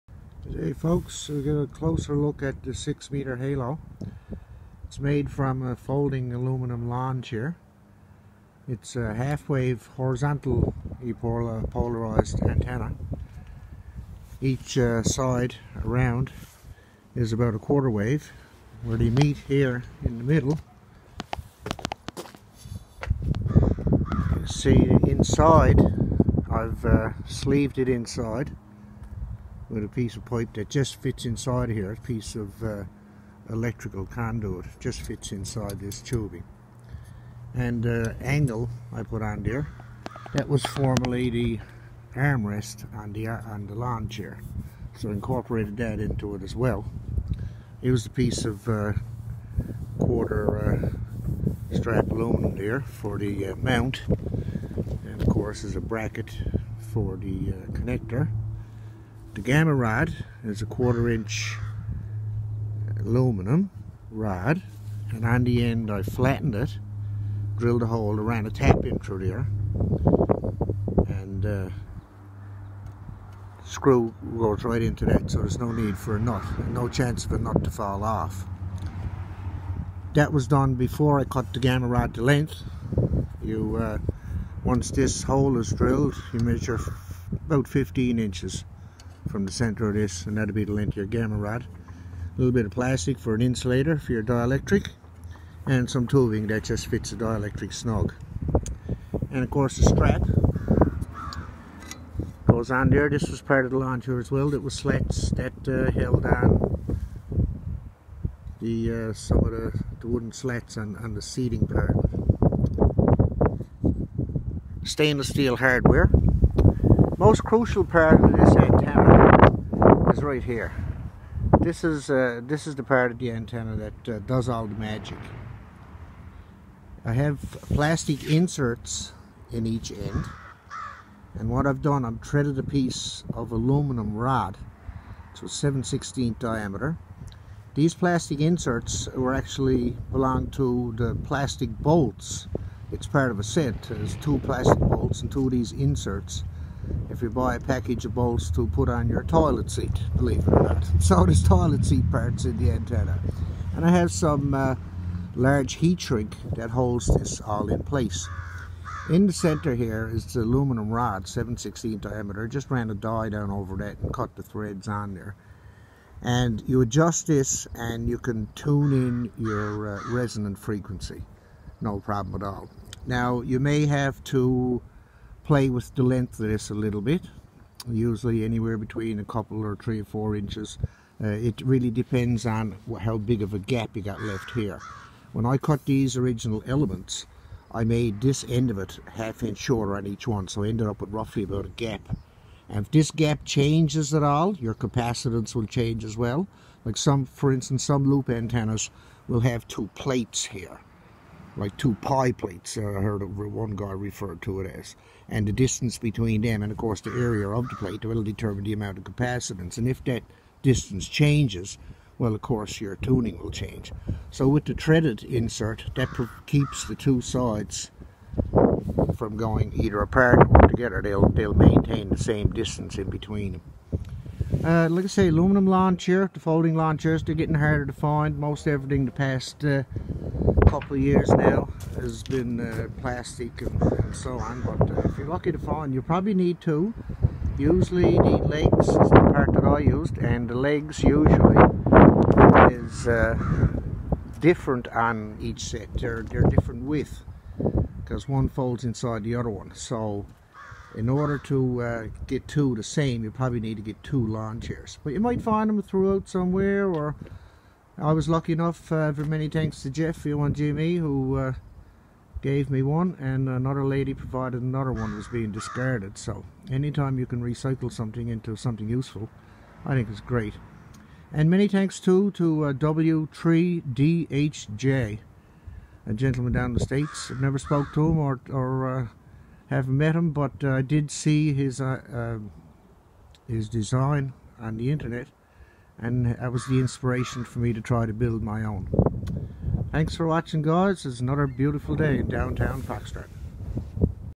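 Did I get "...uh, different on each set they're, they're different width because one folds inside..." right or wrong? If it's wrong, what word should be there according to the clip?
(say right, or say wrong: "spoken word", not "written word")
right.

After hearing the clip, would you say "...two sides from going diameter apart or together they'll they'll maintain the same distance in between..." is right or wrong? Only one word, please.
wrong.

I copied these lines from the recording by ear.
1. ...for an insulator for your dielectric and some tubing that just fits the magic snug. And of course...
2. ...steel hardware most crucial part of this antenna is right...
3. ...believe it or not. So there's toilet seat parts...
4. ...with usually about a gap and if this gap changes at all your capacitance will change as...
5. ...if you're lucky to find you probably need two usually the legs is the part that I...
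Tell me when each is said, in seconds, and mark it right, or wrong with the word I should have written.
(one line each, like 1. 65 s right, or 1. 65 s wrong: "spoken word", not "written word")
1. 93 s wrong: "dielectric", not "magic"
2. 115 s right
3. 150 s right
4. 191 s wrong: "roughly", not "usually"
5. 235 s right.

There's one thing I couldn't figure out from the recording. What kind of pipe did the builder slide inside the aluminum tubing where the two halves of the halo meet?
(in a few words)
electrical conduit.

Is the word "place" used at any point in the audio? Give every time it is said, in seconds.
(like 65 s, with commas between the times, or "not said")
157 s.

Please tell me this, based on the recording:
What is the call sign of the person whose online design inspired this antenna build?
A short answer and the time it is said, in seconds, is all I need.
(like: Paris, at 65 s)
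W3DHJ, at 272 s.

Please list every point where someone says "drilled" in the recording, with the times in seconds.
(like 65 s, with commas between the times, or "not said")
67 s, 85 s.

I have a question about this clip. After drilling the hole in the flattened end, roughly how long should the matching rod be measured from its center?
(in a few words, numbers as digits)
15 inches.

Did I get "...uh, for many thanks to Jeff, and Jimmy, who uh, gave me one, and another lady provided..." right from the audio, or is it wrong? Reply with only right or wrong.
right.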